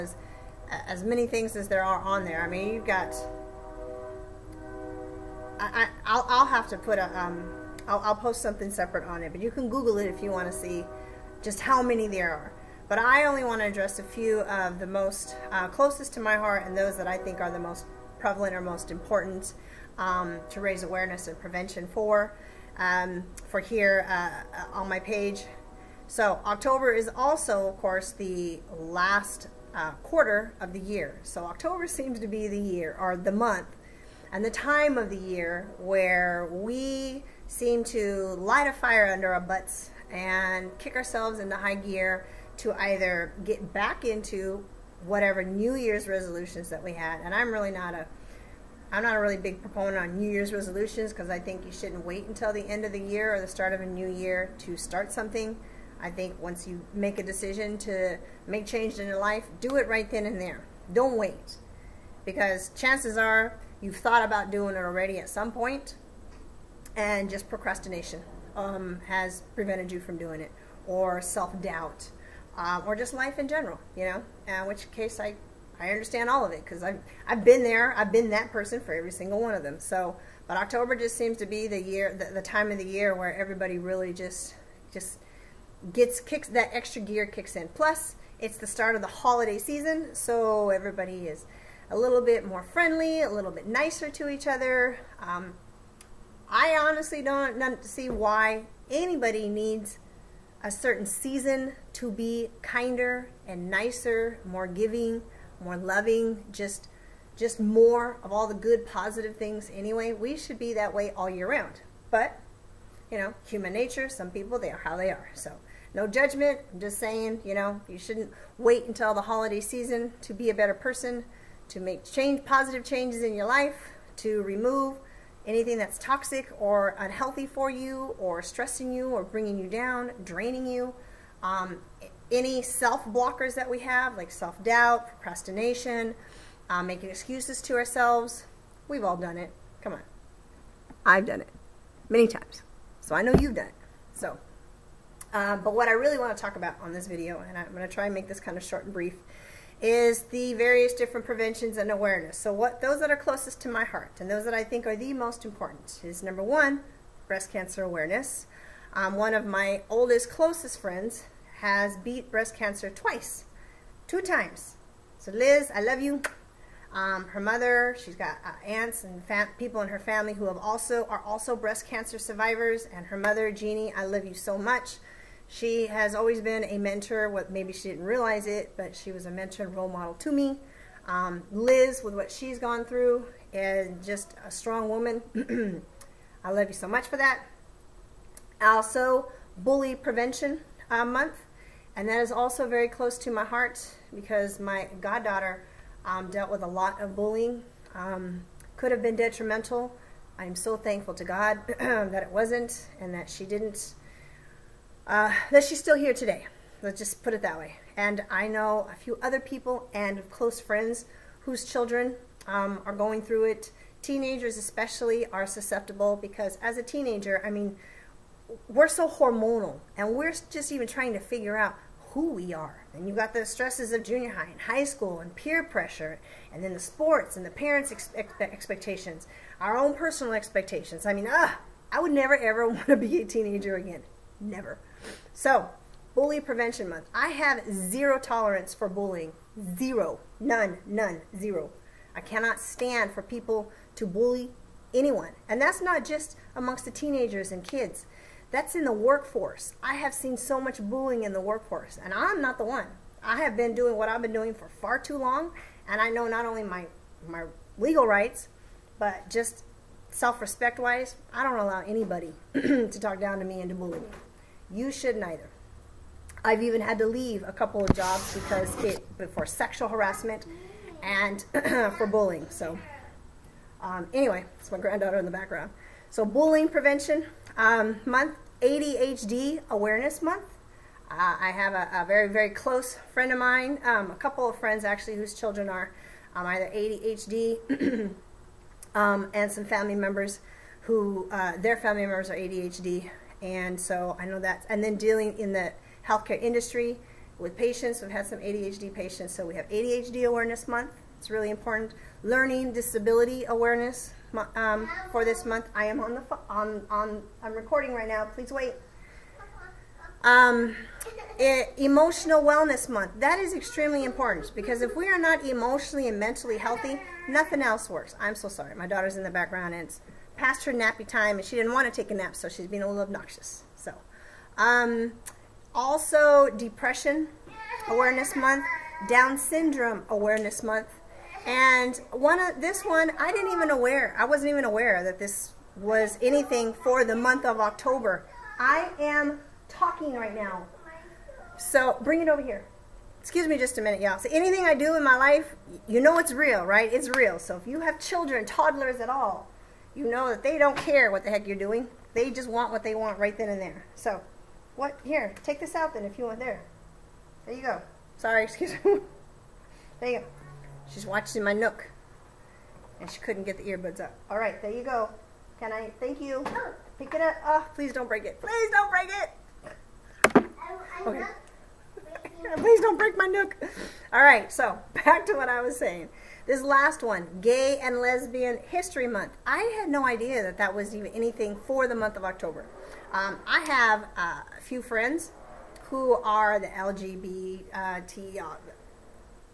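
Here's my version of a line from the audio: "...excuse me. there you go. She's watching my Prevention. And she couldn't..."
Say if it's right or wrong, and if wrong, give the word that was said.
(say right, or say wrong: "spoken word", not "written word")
wrong: "Nook", not "Prevention".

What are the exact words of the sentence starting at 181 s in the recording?
Um, Liz, with what she's gone through, and just a strong woman.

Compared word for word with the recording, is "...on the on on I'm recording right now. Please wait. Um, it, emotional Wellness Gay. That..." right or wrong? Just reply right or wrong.
wrong.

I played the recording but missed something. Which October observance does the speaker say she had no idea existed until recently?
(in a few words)
Gay and Lesbian History Month.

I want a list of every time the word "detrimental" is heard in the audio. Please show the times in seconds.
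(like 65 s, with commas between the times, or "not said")
199 s.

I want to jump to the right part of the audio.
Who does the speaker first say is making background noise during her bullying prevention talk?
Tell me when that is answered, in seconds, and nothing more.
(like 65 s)
274 s.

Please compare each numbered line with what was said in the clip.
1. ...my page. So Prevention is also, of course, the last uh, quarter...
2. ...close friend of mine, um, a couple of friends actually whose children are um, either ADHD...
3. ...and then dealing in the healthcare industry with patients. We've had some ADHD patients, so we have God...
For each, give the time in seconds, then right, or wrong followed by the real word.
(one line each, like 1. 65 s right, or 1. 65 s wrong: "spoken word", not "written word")
1. 24 s wrong: "October", not "Prevention"
2. 282 s right
3. 294 s wrong: "ADHD", not "God".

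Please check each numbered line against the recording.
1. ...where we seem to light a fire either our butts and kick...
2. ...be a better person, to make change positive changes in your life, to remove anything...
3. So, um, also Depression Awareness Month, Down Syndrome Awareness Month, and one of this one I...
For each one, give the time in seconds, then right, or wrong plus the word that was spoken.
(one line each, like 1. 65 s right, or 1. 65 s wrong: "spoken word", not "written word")
1. 35 s wrong: "under", not "either"
2. 120 s right
3. 323 s right.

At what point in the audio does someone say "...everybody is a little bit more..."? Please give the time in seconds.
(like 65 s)
90 s.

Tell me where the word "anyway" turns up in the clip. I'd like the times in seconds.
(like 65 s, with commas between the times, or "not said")
109 s, 274 s.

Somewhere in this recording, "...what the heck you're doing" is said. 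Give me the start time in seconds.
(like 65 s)
351 s.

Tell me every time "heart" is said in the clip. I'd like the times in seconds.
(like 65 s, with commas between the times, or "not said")
16 s, 153 s, 193 s.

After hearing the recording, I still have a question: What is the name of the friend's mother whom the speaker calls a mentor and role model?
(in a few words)
Jeannie.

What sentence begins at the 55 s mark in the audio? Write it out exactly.
I think once you make a decision to make change in your life, do it right then and there.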